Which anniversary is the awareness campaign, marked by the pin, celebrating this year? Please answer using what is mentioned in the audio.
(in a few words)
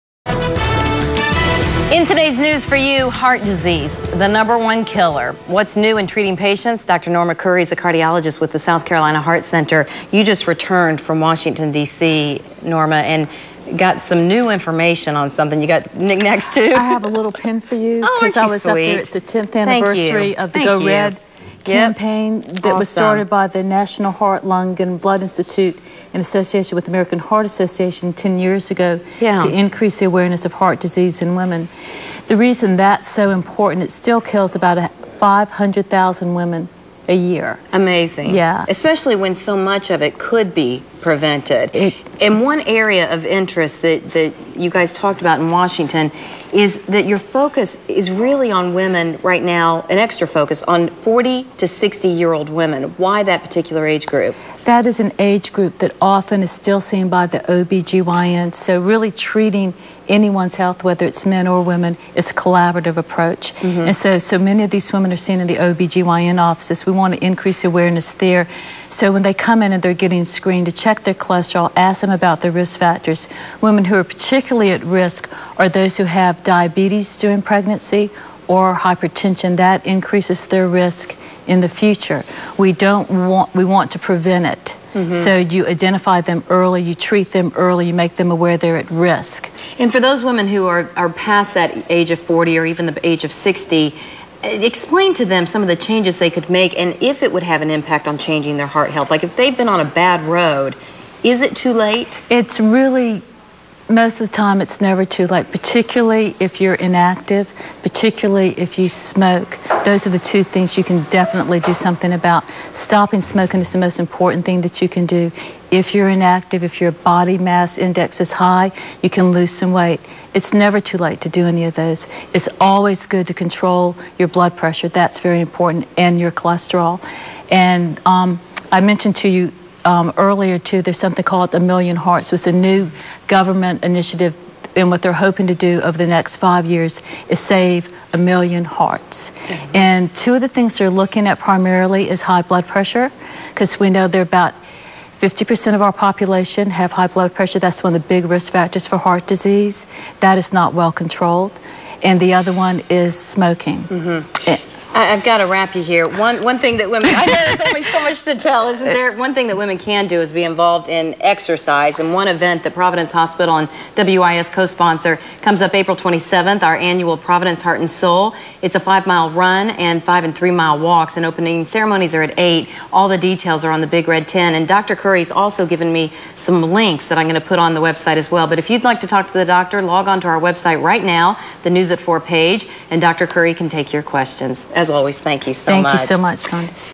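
10th.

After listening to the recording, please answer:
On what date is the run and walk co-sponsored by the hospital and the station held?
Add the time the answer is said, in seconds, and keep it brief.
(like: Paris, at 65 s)
April 27th, at 165 s.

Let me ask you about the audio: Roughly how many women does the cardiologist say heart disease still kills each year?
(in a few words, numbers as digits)
500,000.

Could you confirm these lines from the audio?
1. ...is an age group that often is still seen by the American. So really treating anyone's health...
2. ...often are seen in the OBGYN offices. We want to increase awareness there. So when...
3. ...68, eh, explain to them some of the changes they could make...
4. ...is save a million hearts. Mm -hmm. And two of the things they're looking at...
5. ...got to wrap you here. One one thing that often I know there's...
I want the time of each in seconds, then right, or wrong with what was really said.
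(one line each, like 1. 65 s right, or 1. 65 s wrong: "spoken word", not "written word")
1. 54 s wrong: "OBGYN", not "American"
2. 64 s wrong: "women", not "often"
3. 93 s wrong: "60", not "68"
4. 137 s right
5. 155 s wrong: "women", not "often".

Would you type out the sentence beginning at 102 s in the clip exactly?
It's really most of the time it's never too late, particularly if you're inactive, particularly if you smoke.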